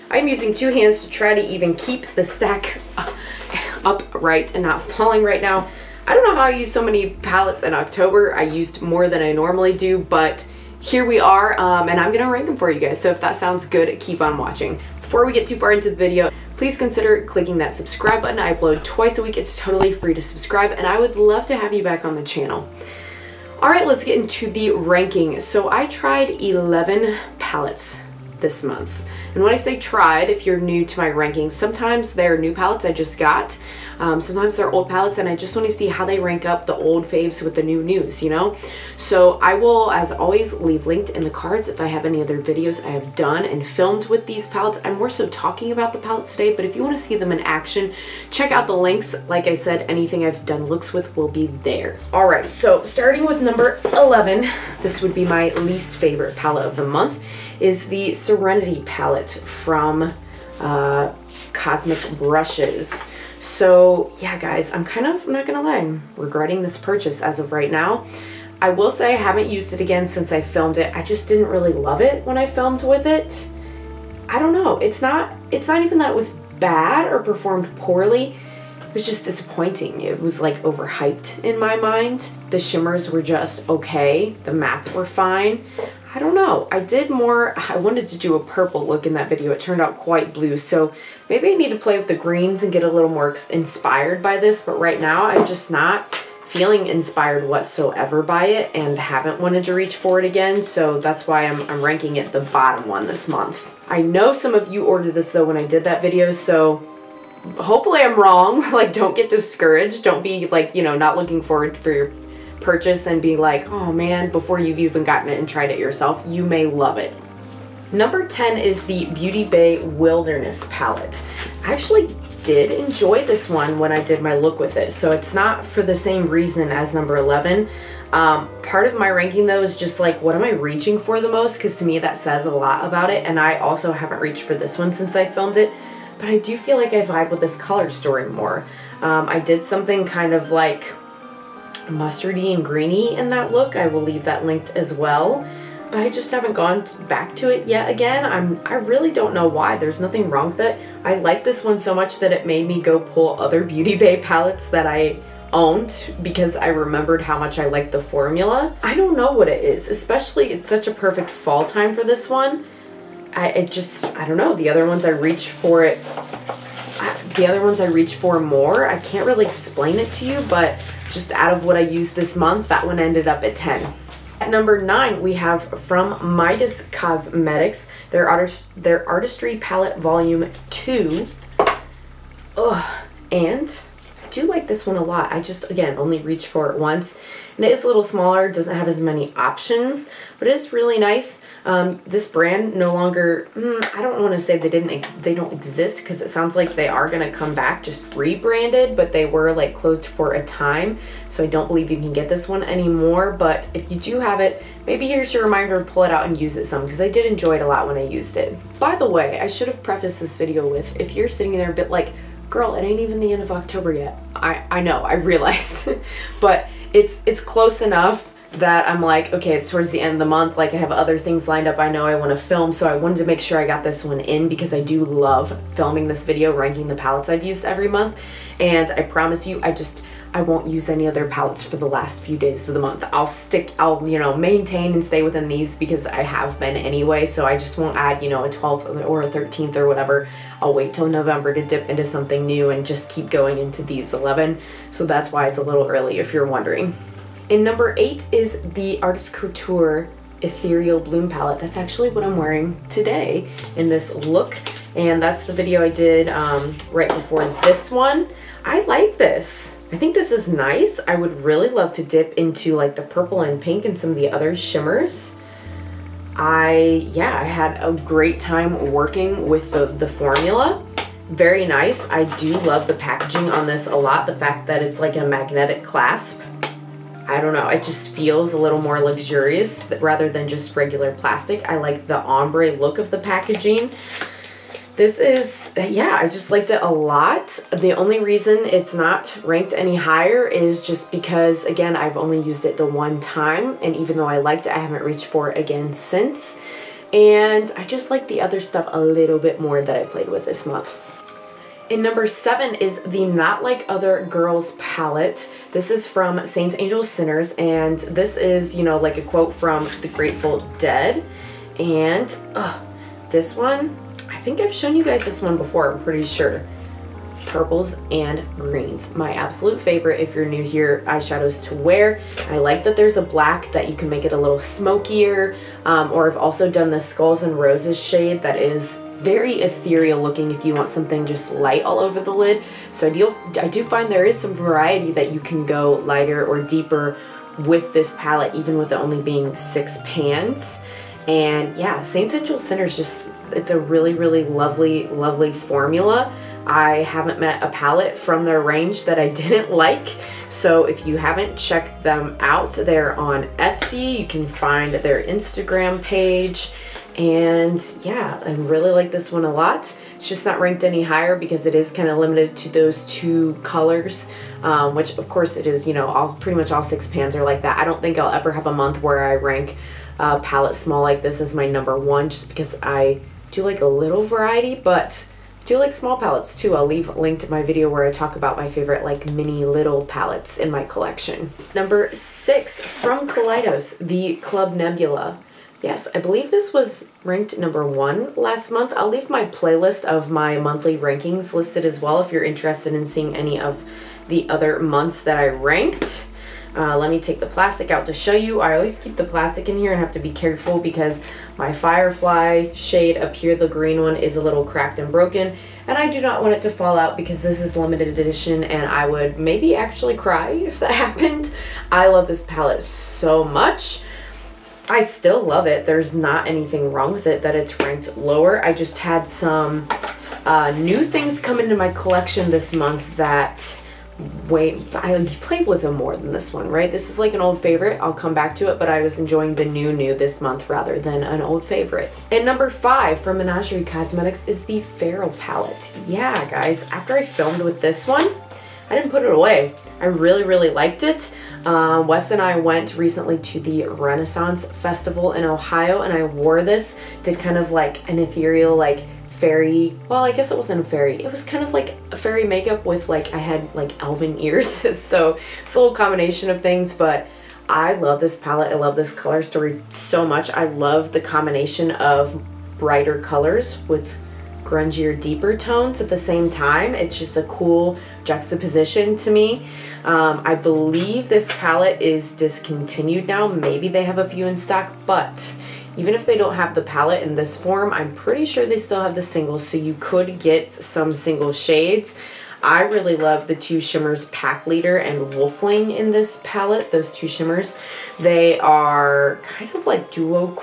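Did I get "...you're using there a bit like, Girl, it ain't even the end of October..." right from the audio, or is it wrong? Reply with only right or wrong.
wrong.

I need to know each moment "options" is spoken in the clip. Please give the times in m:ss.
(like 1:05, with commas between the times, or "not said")
3:09.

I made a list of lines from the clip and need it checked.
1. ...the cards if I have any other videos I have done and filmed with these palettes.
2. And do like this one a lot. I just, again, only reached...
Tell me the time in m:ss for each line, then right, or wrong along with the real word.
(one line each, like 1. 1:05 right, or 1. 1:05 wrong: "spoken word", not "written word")
1. 0:41 right
2. 3:03 right.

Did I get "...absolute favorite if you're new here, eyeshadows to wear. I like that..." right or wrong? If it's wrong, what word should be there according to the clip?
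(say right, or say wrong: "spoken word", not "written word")
right.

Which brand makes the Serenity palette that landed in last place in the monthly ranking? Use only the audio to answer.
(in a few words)
Cosmic Brushes.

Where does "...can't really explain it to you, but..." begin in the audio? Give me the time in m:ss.
2:49.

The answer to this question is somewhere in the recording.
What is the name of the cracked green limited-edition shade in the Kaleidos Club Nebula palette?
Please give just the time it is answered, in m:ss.
6:41.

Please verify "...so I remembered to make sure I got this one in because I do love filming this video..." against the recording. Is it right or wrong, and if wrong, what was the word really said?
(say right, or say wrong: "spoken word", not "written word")
wrong: "wanted", not "remembered".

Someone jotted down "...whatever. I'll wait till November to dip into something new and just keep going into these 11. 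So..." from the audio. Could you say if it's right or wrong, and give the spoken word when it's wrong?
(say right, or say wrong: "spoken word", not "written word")
right.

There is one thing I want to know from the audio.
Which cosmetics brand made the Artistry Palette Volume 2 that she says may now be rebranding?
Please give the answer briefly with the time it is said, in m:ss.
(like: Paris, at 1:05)
Midas Cosmetics, at 2:56.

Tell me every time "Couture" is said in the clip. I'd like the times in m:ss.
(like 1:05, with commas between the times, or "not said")
4:09.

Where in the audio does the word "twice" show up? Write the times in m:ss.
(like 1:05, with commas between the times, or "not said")
0:18.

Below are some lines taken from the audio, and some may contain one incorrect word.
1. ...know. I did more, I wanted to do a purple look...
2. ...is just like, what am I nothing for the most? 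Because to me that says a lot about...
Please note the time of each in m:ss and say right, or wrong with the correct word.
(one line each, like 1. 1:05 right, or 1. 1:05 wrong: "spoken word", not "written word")
1. 1:26 right
2. 2:09 wrong: "reaching", not "nothing".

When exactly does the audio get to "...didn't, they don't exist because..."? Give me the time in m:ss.
3:14.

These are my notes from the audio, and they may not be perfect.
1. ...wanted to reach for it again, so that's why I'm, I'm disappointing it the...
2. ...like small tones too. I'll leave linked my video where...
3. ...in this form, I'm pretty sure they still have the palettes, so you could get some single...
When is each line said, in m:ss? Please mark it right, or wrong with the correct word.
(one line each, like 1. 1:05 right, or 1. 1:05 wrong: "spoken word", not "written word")
1. 1:39 wrong: "ranking", not "disappointing"
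2. 6:15 wrong: "palettes", not "tones"
3. 7:57 wrong: "singles", not "palettes".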